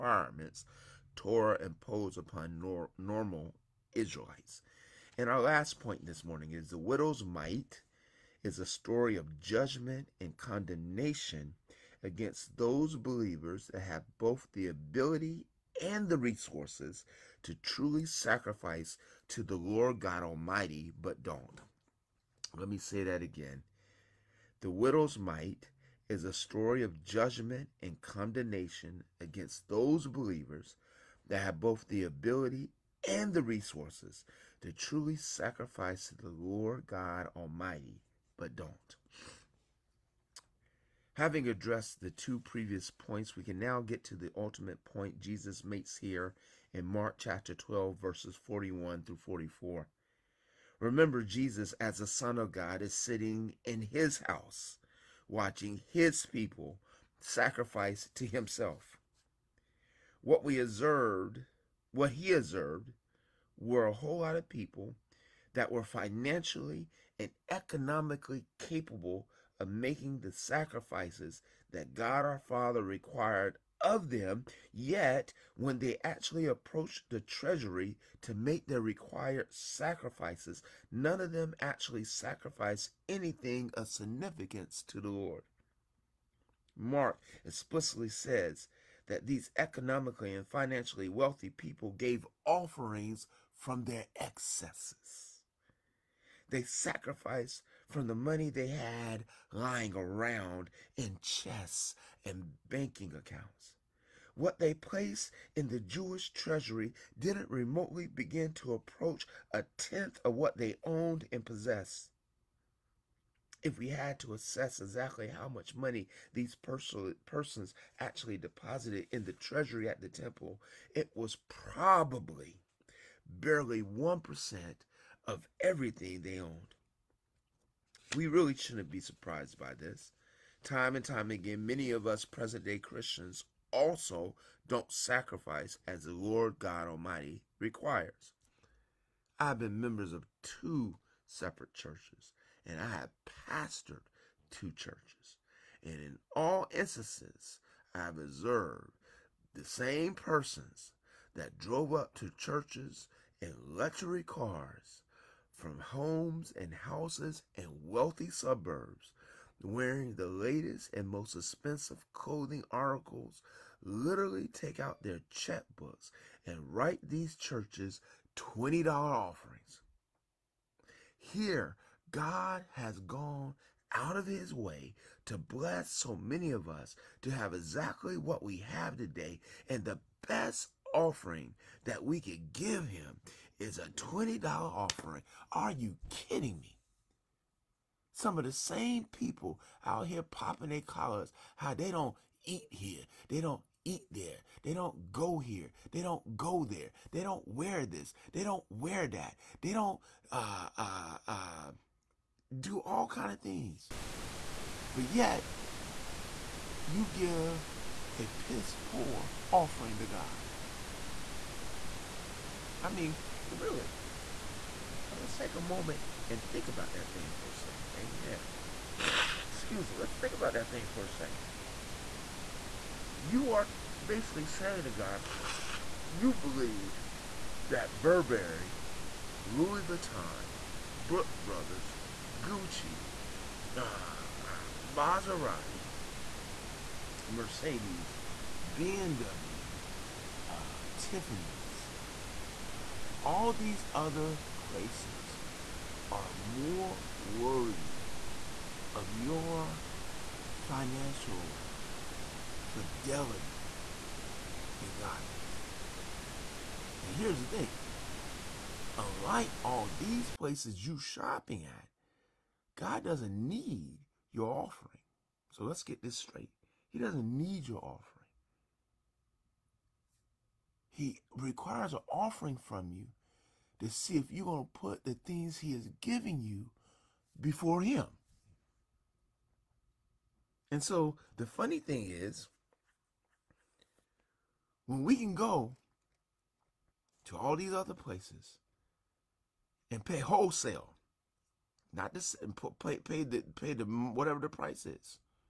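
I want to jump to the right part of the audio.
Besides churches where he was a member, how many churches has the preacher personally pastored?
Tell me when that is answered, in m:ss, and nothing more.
2:24.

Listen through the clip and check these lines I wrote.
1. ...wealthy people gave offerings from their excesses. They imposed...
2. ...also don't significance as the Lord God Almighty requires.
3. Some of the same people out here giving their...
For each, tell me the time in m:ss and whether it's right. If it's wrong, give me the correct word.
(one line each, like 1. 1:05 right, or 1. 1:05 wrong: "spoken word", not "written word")
1. 1:31 wrong: "sacrificed", not "imposed"
2. 2:13 wrong: "sacrifice", not "significance"
3. 3:08 wrong: "popping", not "giving".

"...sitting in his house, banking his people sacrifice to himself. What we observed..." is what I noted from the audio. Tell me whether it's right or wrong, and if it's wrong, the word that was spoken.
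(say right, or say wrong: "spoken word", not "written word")
wrong: "watching", not "banking".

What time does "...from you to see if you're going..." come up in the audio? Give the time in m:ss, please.
4:32.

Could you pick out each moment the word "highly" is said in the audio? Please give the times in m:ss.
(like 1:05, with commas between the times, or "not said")
not said.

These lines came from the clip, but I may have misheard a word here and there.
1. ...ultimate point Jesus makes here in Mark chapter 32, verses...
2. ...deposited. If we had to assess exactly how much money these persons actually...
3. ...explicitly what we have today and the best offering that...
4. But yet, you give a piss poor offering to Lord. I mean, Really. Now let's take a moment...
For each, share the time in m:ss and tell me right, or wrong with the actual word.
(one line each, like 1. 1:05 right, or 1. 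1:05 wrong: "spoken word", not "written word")
1. 0:44 wrong: "12", not "32"
2. 1:51 wrong: "possessed", not "deposited"
3. 2:57 wrong: "exactly", not "explicitly"
4. 3:24 wrong: "God", not "Lord".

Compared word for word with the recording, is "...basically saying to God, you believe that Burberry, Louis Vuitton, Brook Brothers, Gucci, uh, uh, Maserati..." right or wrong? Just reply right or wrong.
right.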